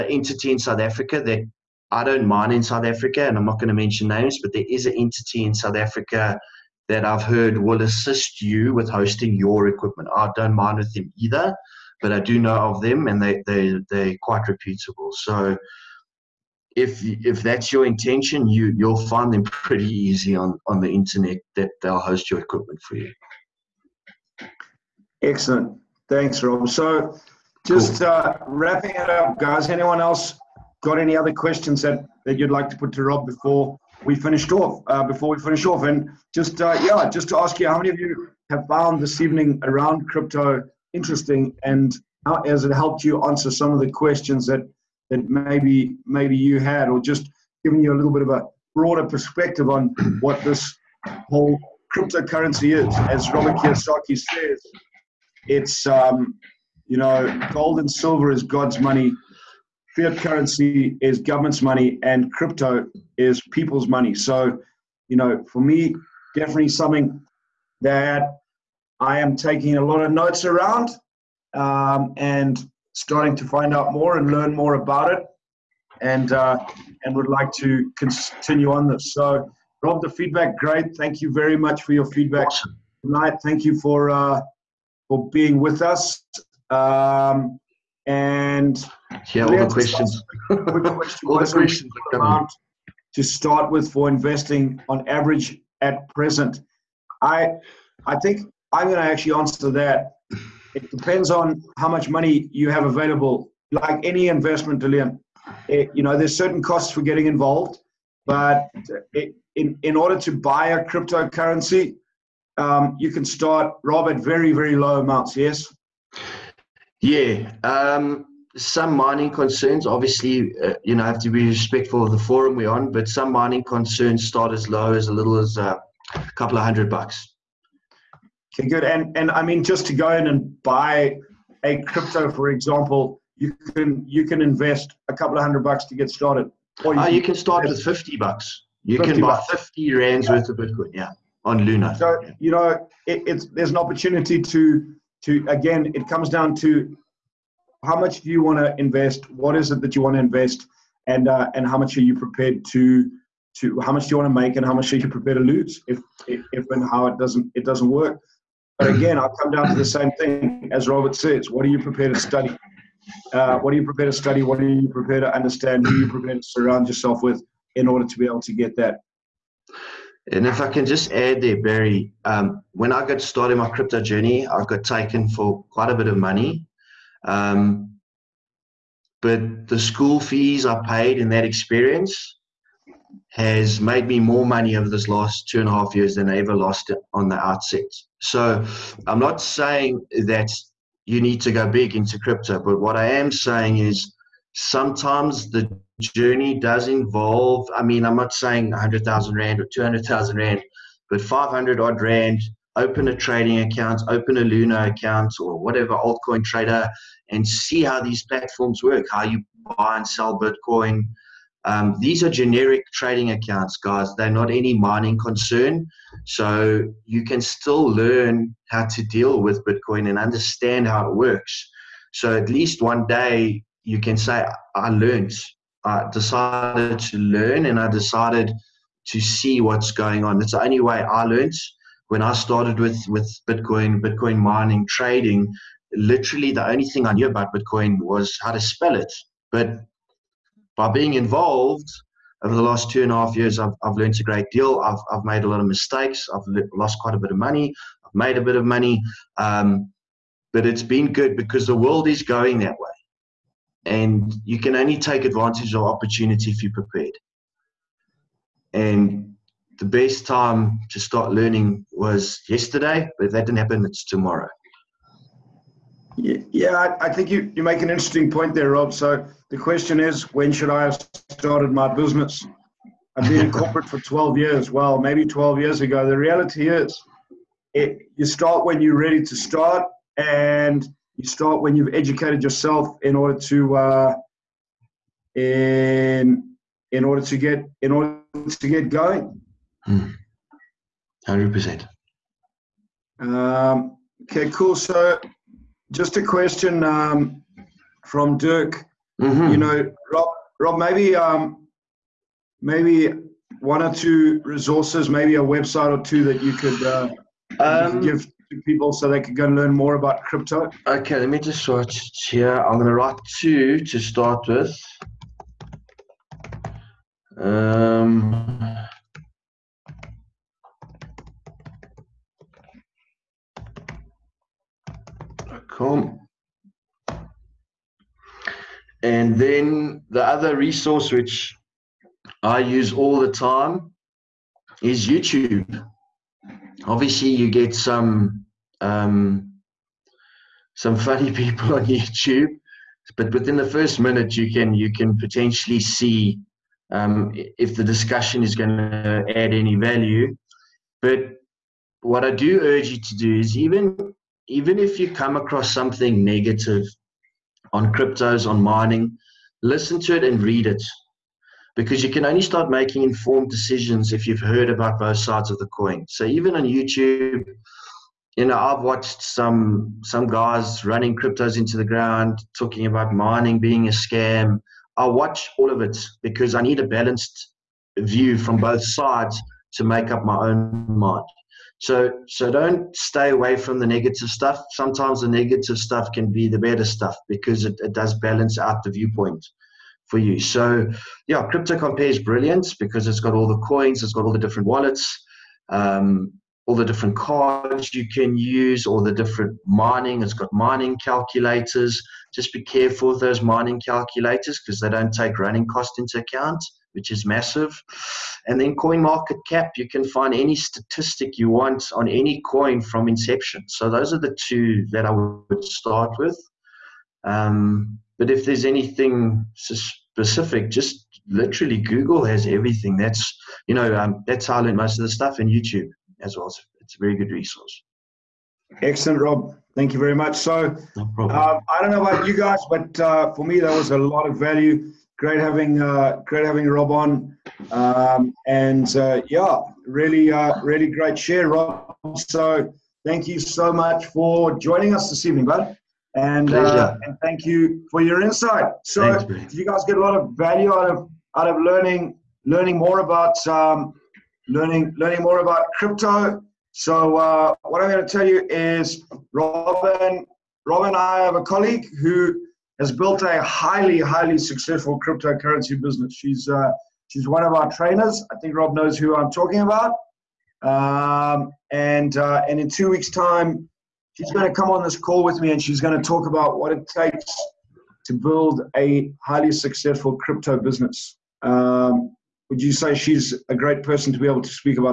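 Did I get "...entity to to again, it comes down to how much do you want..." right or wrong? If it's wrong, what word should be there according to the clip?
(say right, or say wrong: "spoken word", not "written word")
wrong: "opportunity", not "entity".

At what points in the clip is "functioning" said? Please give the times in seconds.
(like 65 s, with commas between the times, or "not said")
not said.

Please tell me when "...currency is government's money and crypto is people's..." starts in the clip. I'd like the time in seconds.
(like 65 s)
60 s.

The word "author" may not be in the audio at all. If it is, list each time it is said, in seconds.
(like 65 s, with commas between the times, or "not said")
not said.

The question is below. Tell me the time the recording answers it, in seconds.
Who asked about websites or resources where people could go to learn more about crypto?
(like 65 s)
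298 s.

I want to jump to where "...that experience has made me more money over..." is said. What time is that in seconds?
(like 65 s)
181 s.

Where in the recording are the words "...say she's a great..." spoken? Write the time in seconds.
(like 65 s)
482 s.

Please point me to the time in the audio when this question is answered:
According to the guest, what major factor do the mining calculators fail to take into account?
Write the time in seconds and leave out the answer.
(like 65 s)
405 s.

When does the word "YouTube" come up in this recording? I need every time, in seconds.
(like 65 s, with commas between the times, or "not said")
335 s, 341 s, 366 s, 425 s.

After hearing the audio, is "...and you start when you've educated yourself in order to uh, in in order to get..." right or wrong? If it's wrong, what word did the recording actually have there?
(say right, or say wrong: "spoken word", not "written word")
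right.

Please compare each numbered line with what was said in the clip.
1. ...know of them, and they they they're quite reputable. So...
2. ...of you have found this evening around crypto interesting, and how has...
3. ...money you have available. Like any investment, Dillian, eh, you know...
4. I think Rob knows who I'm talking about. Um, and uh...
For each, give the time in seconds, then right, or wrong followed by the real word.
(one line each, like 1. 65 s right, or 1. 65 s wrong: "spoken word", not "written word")
1. 12 s right
2. 37 s right
3. 102 s right
4. 468 s right.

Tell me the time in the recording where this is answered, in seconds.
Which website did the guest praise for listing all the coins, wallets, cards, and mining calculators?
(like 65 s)
391 s.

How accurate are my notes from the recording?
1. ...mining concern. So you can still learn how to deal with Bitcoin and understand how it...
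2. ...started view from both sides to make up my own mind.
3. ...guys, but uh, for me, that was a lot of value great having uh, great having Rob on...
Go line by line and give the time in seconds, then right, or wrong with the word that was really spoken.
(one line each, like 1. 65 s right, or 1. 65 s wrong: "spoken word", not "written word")
1. 214 s right
2. 376 s wrong: "balanced", not "started"
3. 432 s right.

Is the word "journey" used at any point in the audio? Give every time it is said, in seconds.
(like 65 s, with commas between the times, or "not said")
174 s, 196 s.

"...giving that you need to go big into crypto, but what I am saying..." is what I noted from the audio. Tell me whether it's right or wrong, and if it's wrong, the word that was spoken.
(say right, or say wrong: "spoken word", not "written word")
wrong: "saying", not "giving".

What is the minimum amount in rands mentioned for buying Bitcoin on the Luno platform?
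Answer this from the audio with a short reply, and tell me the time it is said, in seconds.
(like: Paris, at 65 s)
50, at 139 s.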